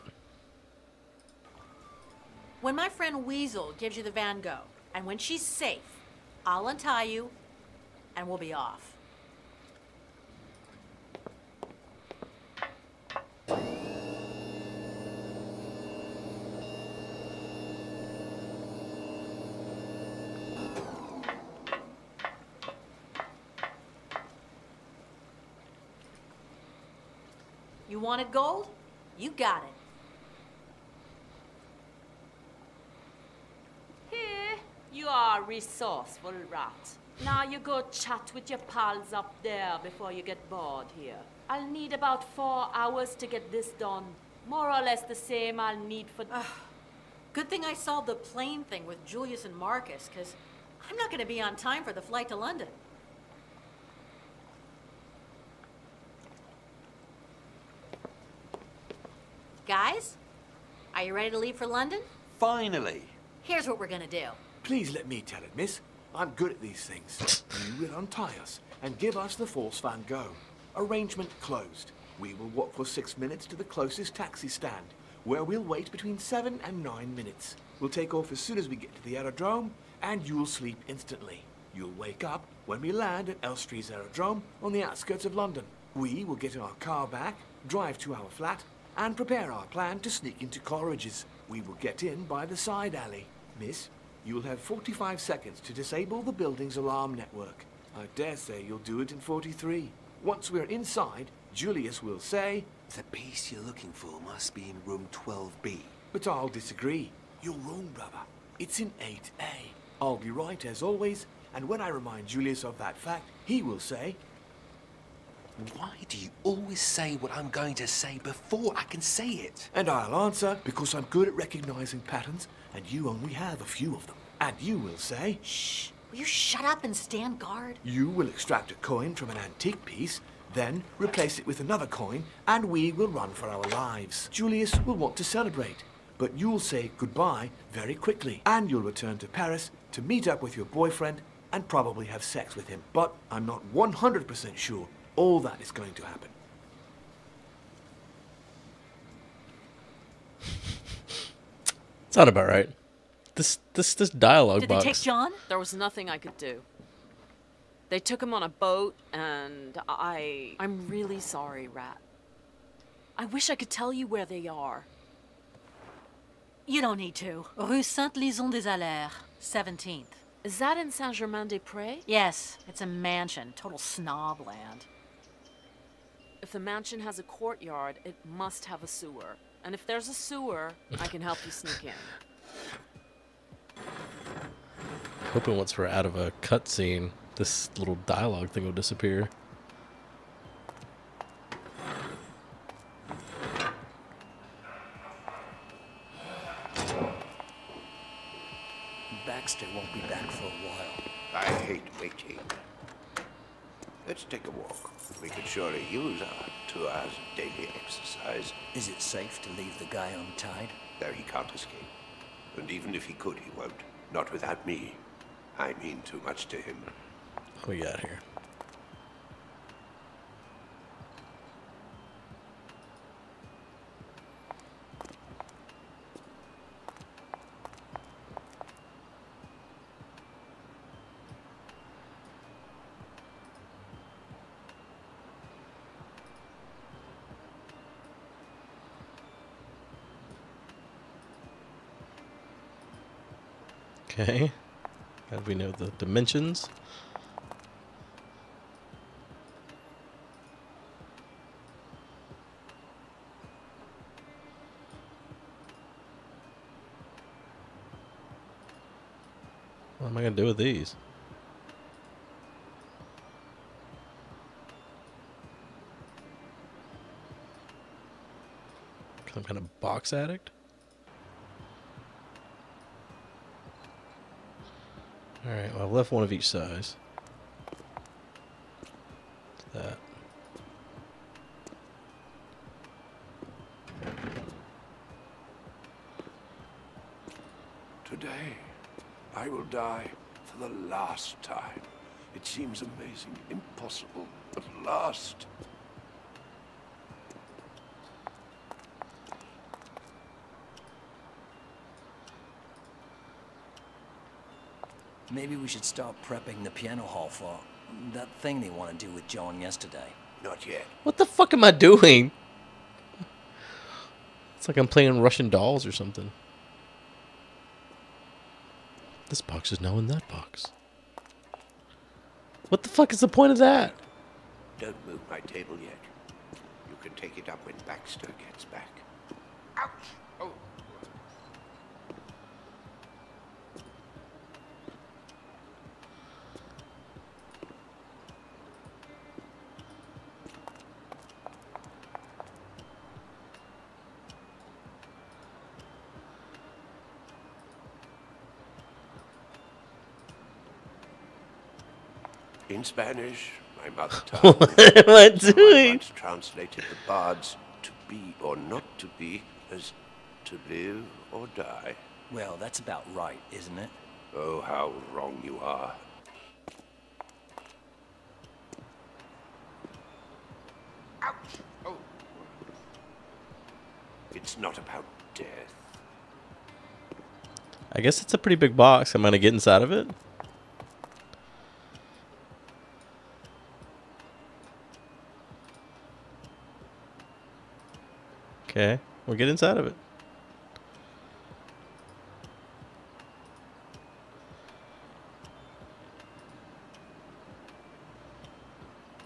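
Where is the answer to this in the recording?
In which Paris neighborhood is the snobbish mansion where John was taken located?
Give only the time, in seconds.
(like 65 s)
170 s.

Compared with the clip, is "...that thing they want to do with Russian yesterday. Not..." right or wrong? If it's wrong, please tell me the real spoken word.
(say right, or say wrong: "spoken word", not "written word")
wrong: "John", not "Russian".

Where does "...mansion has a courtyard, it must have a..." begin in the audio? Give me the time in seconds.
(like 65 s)
176 s.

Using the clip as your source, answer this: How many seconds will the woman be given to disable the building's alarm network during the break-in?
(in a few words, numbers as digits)
45.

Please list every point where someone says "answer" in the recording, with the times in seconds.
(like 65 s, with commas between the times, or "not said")
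120 s.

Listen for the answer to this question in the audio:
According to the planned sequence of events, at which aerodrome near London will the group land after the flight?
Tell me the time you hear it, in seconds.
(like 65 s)
83 s.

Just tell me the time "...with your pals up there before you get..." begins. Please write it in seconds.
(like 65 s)
38 s.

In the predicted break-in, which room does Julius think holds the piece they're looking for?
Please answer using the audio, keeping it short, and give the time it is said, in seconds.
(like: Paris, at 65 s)
12B, at 105 s.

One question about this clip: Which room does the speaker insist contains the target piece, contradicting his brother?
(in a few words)
8A.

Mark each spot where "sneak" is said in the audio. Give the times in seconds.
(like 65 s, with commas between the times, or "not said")
90 s, 181 s.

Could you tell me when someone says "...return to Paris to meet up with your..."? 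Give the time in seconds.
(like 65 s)
138 s.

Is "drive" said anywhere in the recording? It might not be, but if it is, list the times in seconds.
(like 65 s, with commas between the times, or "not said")
87 s.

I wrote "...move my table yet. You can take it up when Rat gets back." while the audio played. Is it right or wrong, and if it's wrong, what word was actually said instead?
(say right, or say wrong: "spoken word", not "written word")
wrong: "Baxter", not "Rat".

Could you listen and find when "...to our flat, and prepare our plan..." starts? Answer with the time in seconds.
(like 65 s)
87 s.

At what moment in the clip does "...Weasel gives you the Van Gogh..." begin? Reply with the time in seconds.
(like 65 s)
3 s.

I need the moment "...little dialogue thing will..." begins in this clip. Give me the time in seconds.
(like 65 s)
187 s.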